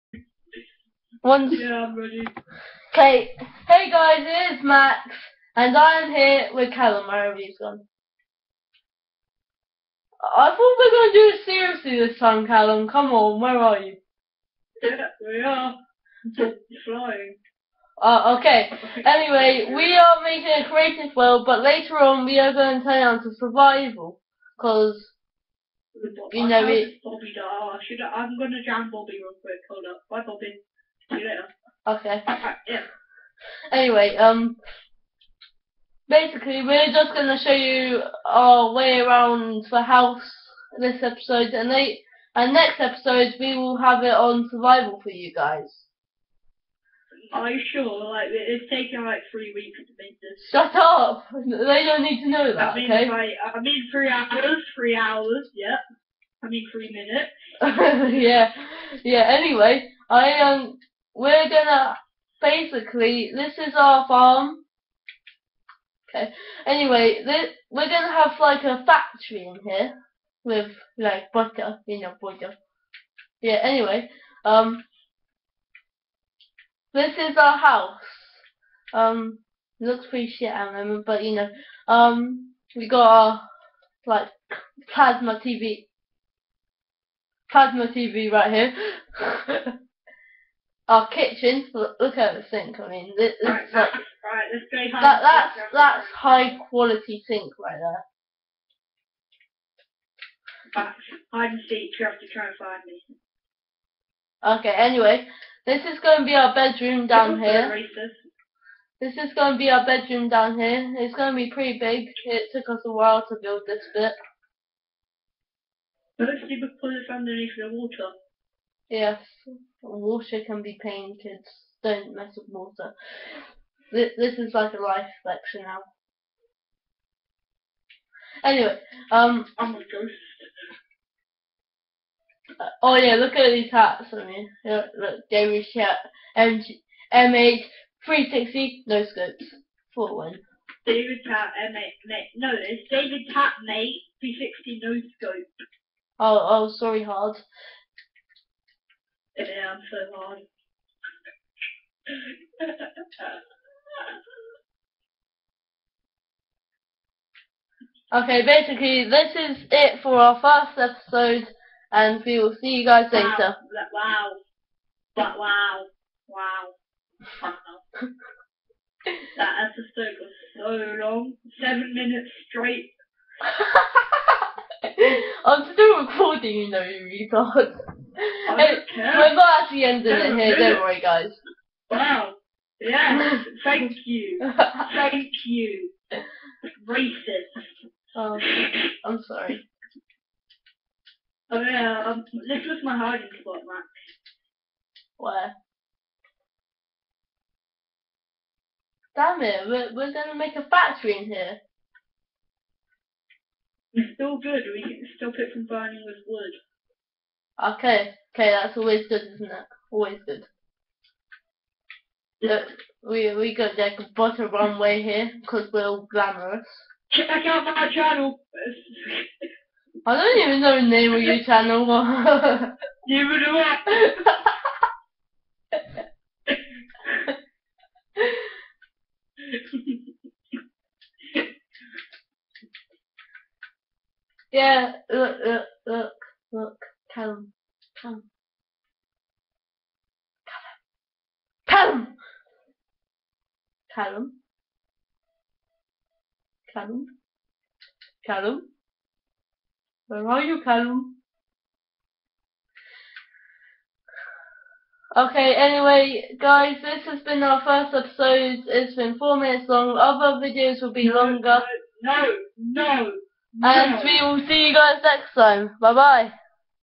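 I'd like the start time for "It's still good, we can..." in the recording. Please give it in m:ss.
3:23.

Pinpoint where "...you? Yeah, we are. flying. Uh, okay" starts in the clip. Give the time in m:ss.
0:13.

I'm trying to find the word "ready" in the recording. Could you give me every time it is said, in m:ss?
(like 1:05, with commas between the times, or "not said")
0:01.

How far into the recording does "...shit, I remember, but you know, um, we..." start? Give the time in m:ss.
1:20.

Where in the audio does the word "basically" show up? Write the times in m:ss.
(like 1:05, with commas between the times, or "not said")
0:36, 1:02, 2:38.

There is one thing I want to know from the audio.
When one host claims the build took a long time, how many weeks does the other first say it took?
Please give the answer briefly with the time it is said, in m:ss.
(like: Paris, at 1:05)
3, at 0:49.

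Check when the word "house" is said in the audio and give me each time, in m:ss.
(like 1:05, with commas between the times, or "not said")
0:39, 1:17.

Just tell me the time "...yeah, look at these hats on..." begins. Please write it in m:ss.
2:12.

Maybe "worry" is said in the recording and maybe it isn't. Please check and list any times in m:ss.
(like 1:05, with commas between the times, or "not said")
3:00.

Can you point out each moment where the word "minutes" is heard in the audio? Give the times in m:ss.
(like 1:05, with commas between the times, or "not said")
0:56, 2:51, 4:19.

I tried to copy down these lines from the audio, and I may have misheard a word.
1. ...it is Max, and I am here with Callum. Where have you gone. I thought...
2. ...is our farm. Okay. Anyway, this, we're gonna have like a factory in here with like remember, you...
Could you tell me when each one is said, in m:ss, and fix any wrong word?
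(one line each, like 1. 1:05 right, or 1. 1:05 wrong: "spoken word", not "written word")
1. 0:04 right
2. 1:03 wrong: "butter", not "remember".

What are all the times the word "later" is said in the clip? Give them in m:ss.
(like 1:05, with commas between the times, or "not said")
0:21, 2:43.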